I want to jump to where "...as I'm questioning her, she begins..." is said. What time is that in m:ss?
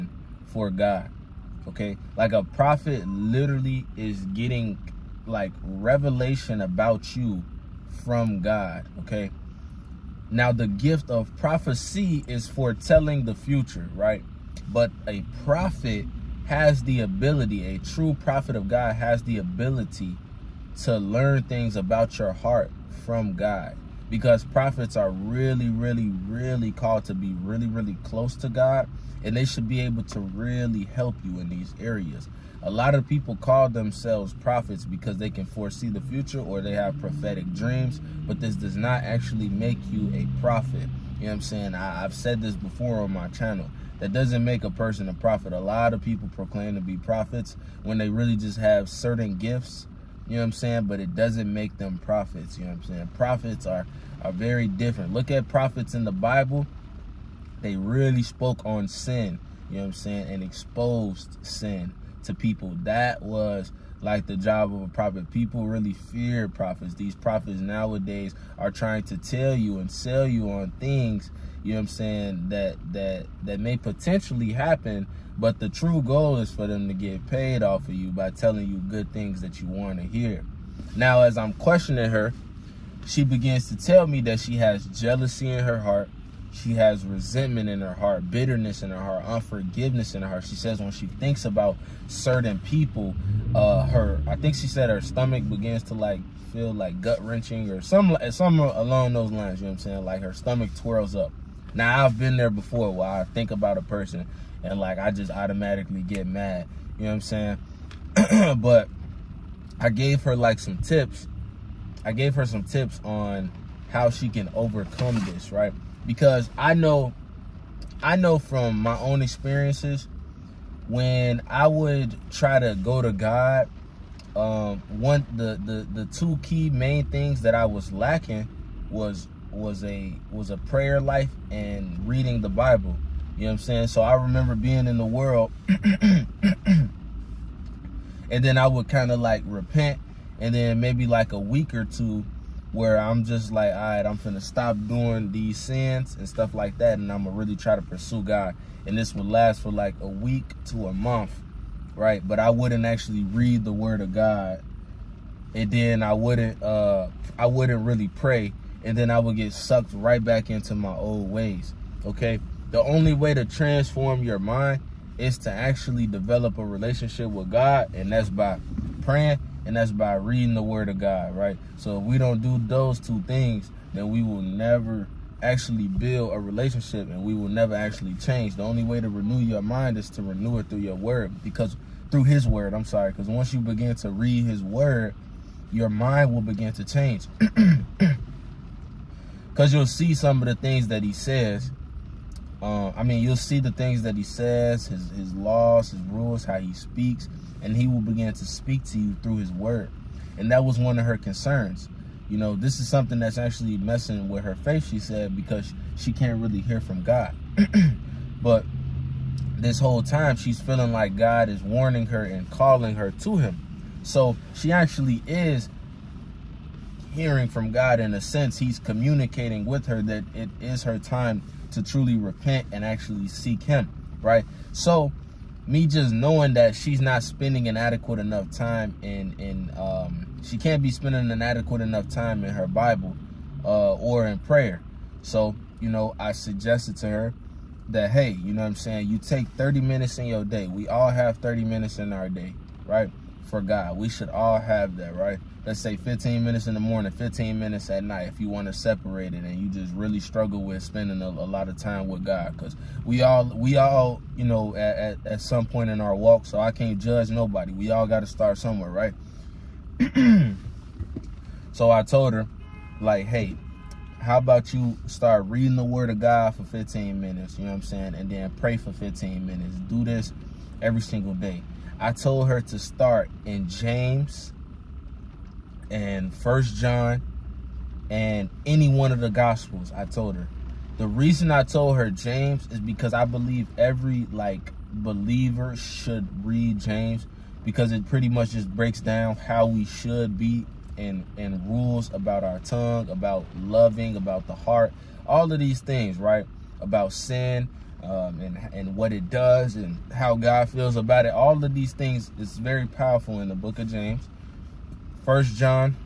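1:21.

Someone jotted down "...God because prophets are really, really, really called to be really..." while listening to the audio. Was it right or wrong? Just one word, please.
right.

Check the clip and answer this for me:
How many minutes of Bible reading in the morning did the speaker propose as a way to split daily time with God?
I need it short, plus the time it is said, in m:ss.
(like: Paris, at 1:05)
15, at 4:05.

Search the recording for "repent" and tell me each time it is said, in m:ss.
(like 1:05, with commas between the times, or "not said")
2:19, 3:42.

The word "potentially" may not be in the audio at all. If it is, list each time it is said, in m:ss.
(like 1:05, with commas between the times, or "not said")
1:13.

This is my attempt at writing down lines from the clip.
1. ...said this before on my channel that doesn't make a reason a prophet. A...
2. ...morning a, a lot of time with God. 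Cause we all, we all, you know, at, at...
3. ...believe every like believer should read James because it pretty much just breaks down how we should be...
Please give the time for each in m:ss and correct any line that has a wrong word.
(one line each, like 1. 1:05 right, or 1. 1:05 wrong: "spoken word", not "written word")
1. 0:42 wrong: "person", not "reason"
2. 4:10 wrong: "spending", not "morning"
3. 4:43 right.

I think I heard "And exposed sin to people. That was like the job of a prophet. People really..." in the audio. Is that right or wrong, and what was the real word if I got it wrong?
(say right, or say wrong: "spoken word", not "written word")
right.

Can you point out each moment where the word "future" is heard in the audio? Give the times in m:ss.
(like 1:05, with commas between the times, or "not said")
0:13, 0:36.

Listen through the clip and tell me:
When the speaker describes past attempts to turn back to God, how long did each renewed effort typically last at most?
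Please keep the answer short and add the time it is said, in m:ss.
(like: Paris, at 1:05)
a month, at 2:29.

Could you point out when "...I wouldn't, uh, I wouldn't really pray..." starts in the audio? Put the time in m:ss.
2:36.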